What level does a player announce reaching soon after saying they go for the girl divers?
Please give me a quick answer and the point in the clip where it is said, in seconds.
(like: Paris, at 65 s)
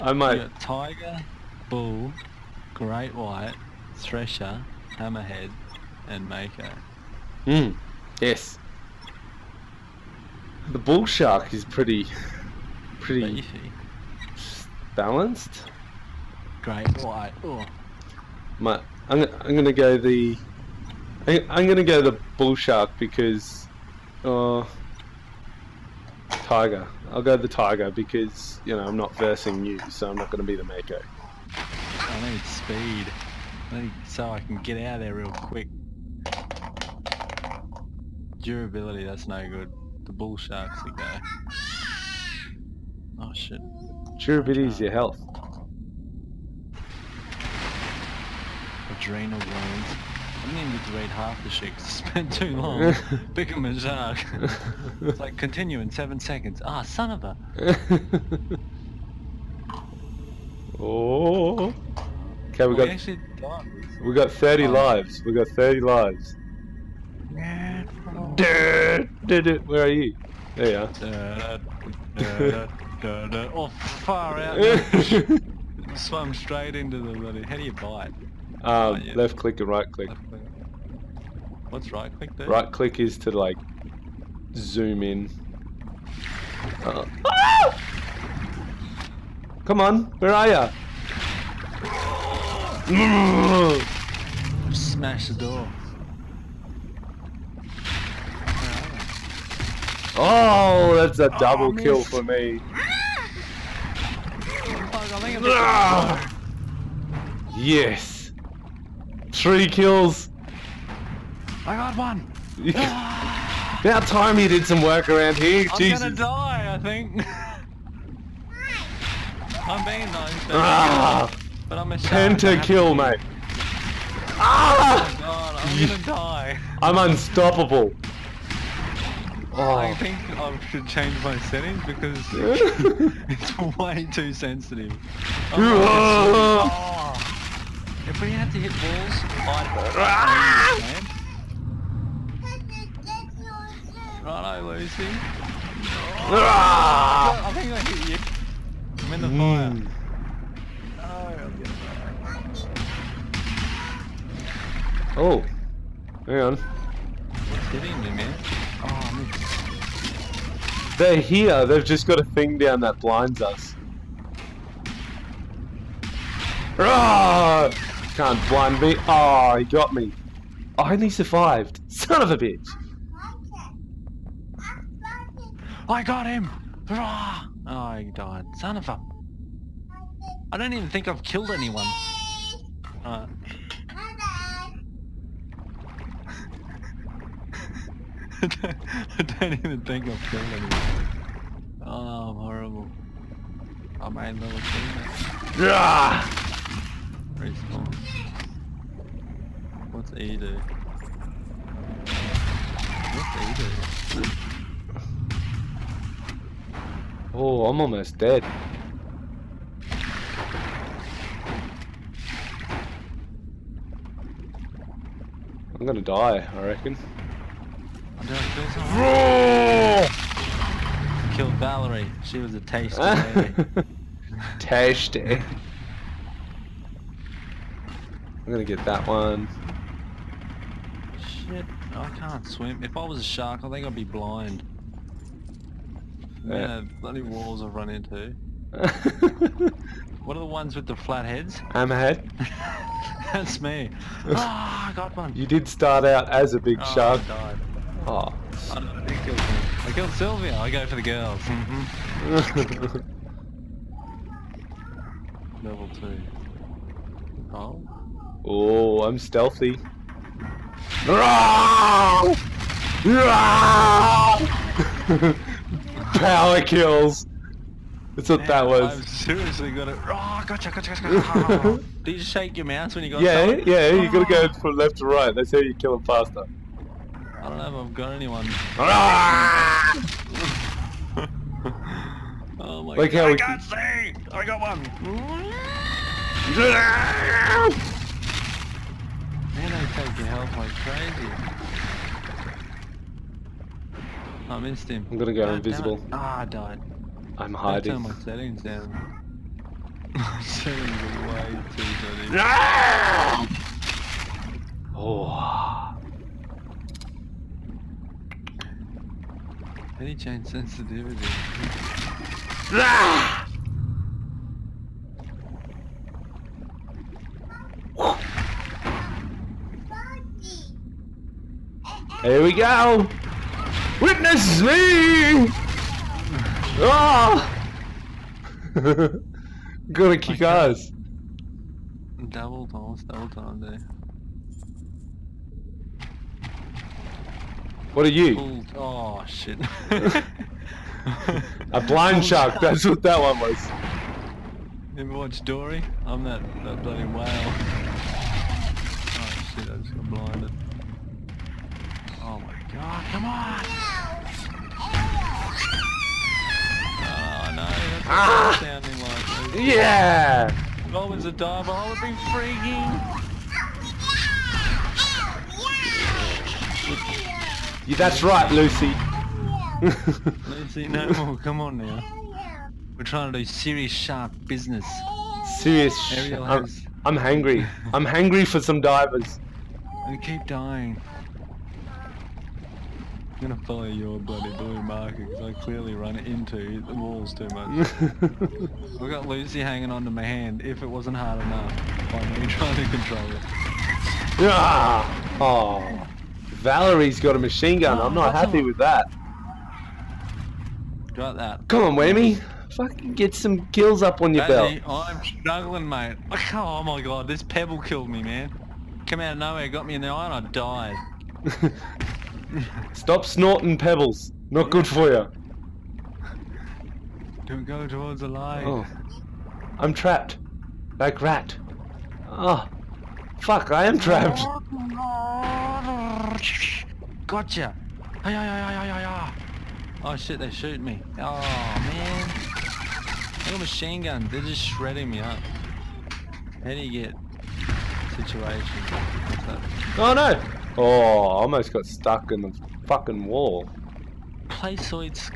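Level two, at 255 s.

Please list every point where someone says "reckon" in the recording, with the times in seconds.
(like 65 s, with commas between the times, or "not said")
216 s.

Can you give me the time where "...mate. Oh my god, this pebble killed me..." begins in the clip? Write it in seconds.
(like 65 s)
405 s.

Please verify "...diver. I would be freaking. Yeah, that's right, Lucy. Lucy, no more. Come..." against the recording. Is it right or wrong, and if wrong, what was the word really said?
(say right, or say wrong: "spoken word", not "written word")
right.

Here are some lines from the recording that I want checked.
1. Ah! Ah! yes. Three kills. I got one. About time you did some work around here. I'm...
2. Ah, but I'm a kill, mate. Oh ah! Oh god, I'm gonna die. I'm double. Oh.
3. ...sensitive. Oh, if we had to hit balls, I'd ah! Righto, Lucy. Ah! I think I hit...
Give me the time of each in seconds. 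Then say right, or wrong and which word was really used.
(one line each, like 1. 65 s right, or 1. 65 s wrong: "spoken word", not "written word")
1. 102 s right
2. 120 s wrong: "unstoppable", not "double"
3. 134 s right.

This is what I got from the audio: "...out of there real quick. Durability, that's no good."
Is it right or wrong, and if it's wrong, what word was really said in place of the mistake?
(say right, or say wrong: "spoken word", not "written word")
right.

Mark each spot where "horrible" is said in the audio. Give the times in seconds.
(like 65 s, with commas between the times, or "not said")
192 s.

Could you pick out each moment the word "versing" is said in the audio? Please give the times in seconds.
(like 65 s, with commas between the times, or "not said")
29 s.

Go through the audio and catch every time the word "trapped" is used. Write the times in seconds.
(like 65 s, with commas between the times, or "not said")
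419 s, 423 s.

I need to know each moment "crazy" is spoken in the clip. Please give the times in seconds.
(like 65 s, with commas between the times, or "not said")
290 s.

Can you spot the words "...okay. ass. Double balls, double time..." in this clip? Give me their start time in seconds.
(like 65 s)
330 s.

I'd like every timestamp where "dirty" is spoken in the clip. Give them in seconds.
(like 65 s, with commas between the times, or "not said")
301 s.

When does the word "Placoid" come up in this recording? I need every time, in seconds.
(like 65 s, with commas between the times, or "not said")
444 s.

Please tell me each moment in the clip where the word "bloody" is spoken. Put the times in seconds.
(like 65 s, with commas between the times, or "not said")
77 s, 236 s, 346 s, 384 s.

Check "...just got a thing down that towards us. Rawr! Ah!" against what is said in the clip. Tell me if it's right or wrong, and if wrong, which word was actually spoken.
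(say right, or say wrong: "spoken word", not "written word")
wrong: "blinds", not "towards".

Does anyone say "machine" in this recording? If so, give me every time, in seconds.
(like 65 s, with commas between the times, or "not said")
397 s, 433 s.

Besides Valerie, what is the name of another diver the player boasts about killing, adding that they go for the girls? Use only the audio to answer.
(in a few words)
Sylvia.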